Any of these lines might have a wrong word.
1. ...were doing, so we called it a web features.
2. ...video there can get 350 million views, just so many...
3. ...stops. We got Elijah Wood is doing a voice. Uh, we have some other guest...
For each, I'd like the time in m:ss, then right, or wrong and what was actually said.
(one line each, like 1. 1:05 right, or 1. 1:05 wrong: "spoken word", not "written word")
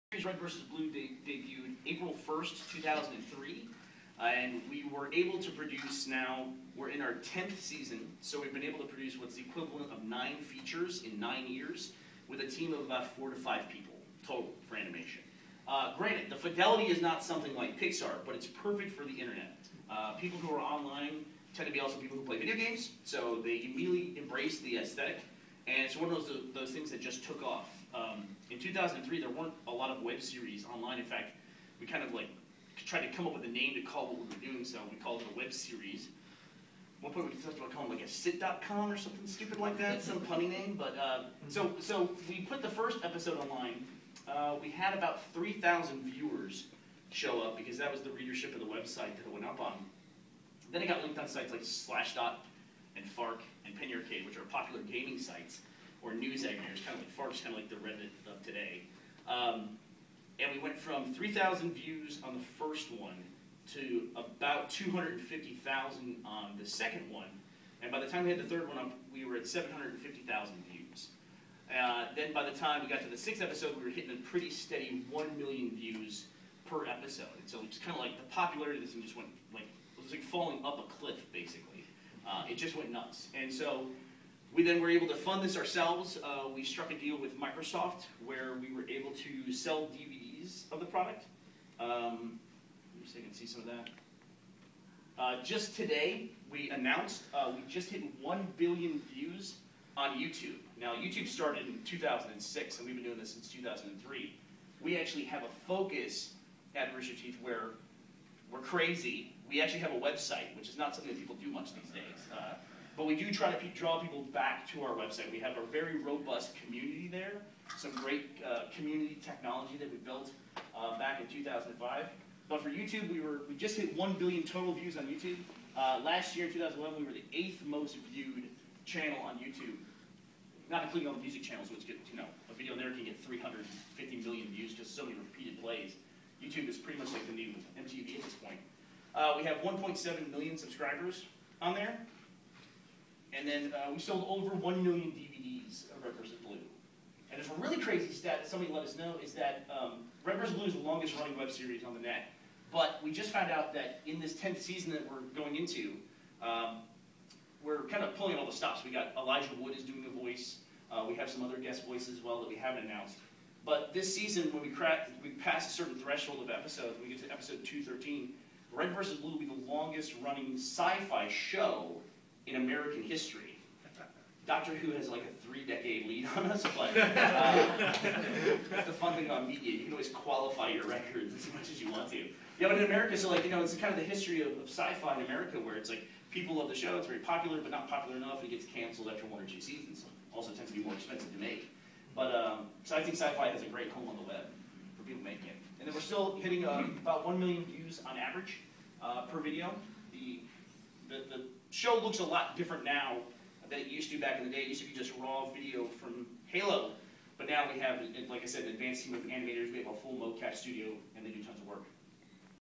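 1. 0:34 wrong: "series", not "features"
2. 2:12 right
3. 2:38 right.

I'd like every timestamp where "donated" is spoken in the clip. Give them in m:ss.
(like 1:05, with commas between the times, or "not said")
not said.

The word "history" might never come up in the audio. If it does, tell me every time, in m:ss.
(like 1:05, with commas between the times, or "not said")
2:53, 3:04.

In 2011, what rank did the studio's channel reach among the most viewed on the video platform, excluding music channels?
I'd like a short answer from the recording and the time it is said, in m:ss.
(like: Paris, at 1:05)
8th, at 2:07.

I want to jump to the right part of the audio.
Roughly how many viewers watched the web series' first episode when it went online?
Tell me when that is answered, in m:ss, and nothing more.
0:45.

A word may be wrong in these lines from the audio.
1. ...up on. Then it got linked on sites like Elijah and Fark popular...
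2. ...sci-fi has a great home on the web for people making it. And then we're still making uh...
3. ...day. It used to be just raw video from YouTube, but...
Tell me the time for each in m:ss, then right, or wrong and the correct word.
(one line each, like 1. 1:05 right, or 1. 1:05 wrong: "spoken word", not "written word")
1. 0:49 wrong: "Slashdot", not "Elijah"
2. 3:13 wrong: "hitting", not "making"
3. 3:24 wrong: "Halo", not "YouTube".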